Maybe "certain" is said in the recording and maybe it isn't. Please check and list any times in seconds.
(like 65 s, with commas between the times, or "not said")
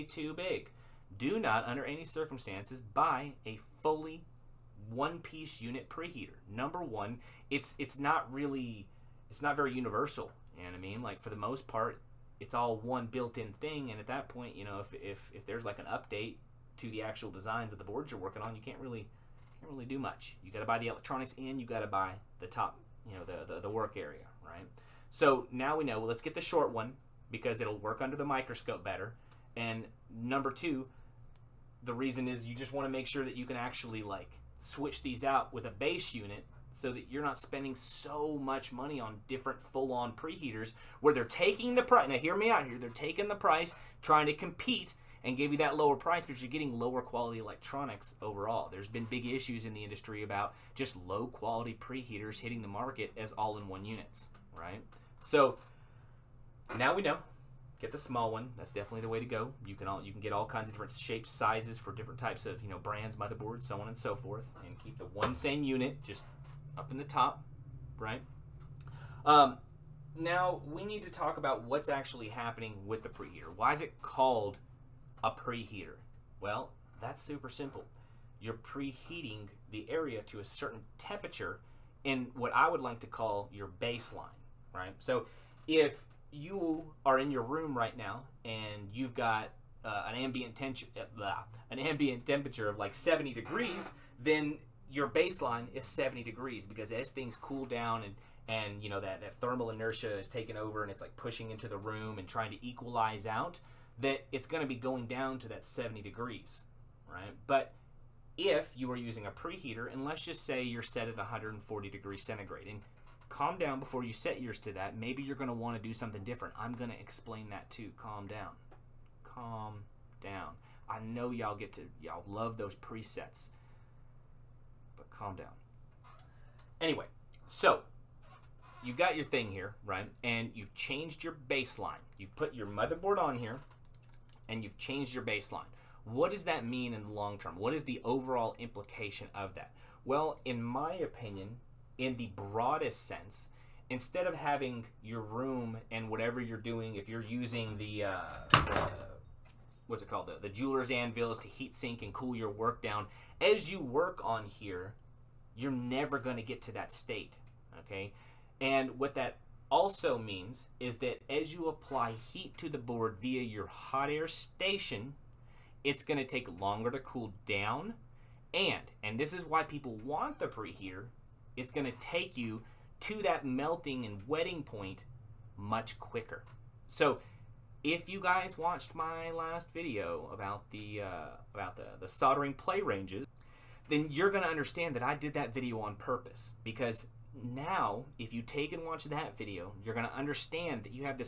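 80 s.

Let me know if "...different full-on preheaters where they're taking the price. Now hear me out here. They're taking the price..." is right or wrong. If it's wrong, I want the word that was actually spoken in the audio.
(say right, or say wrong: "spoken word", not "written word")
right.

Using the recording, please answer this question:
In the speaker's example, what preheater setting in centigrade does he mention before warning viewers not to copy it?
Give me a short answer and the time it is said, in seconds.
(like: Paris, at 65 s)
140 degrees, at 111 s.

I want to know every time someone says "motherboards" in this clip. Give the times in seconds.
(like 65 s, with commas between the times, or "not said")
63 s, 132 s.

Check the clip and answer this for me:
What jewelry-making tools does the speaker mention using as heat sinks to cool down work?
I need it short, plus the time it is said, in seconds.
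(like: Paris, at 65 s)
jeweler's anvils, at 150 s.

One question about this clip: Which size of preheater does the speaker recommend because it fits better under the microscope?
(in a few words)
the short one.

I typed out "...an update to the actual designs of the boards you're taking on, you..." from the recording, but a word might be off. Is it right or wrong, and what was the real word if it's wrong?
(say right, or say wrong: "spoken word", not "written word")
wrong: "working", not "taking".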